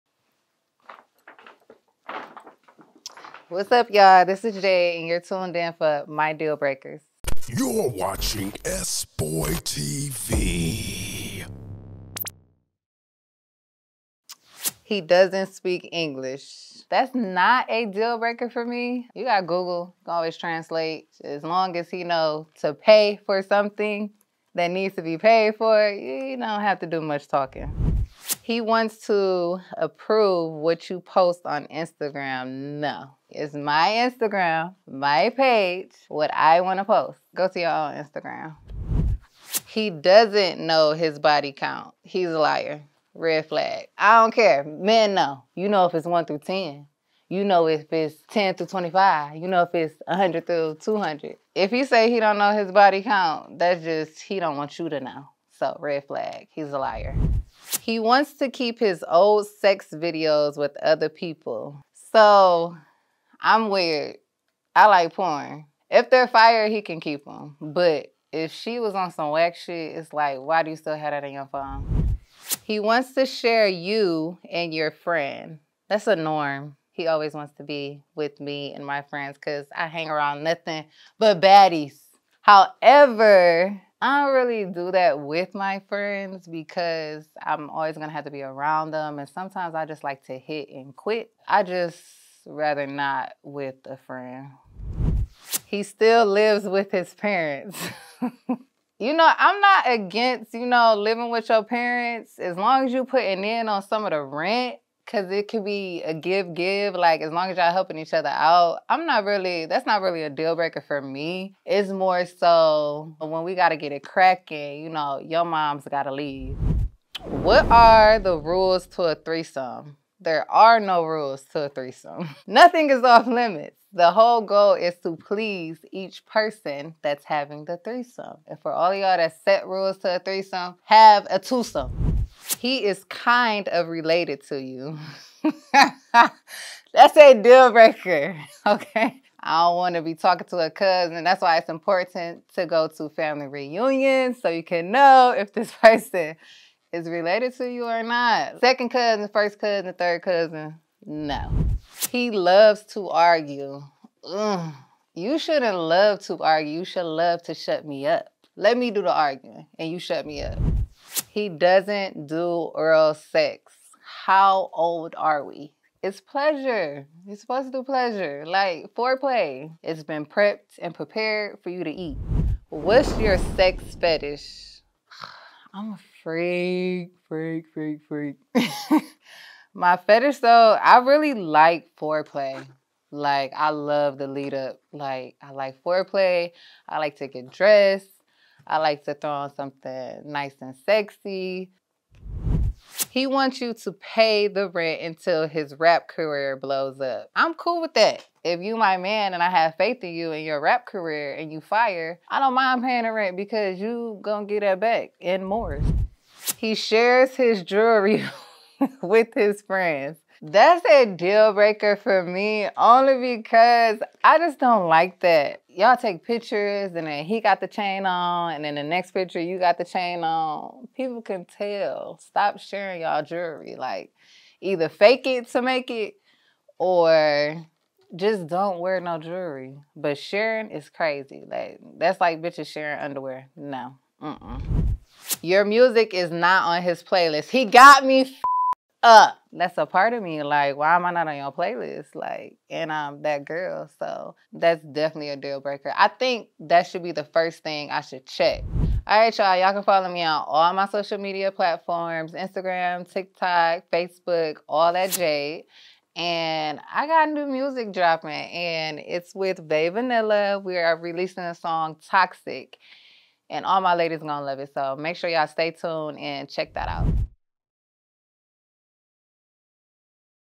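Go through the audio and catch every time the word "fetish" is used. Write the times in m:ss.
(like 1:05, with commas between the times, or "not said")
2:53, 2:59.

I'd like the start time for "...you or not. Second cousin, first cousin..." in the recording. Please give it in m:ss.
2:27.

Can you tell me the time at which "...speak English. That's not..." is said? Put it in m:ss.
0:15.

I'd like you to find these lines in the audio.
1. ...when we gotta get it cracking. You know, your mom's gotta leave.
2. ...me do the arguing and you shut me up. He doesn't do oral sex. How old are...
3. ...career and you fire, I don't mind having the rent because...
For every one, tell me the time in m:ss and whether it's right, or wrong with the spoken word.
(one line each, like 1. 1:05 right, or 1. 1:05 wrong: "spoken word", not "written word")
1. 1:53 right
2. 2:38 right
3. 3:20 wrong: "paying", not "having".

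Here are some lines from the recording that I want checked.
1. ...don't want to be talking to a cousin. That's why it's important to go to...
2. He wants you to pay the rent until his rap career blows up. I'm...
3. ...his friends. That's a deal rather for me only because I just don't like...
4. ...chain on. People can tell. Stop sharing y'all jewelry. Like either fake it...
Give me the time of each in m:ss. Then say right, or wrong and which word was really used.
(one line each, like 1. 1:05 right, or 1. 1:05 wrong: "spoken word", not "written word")
1. 2:19 right
2. 3:13 right
3. 3:29 wrong: "breaker", not "rather"
4. 3:39 right.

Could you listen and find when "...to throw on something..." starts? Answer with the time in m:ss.
3:09.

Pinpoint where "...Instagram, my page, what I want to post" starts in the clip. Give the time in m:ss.
0:34.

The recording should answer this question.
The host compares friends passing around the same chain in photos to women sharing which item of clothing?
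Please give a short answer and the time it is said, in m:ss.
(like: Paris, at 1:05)
Underwear, at 3:52.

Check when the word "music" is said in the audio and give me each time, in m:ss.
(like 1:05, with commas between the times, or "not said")
3:55, 4:17.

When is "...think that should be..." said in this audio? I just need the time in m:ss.
4:06.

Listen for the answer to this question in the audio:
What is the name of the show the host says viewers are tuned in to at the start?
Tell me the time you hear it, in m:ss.
0:06.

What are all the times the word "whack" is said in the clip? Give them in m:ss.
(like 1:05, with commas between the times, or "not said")
1:09.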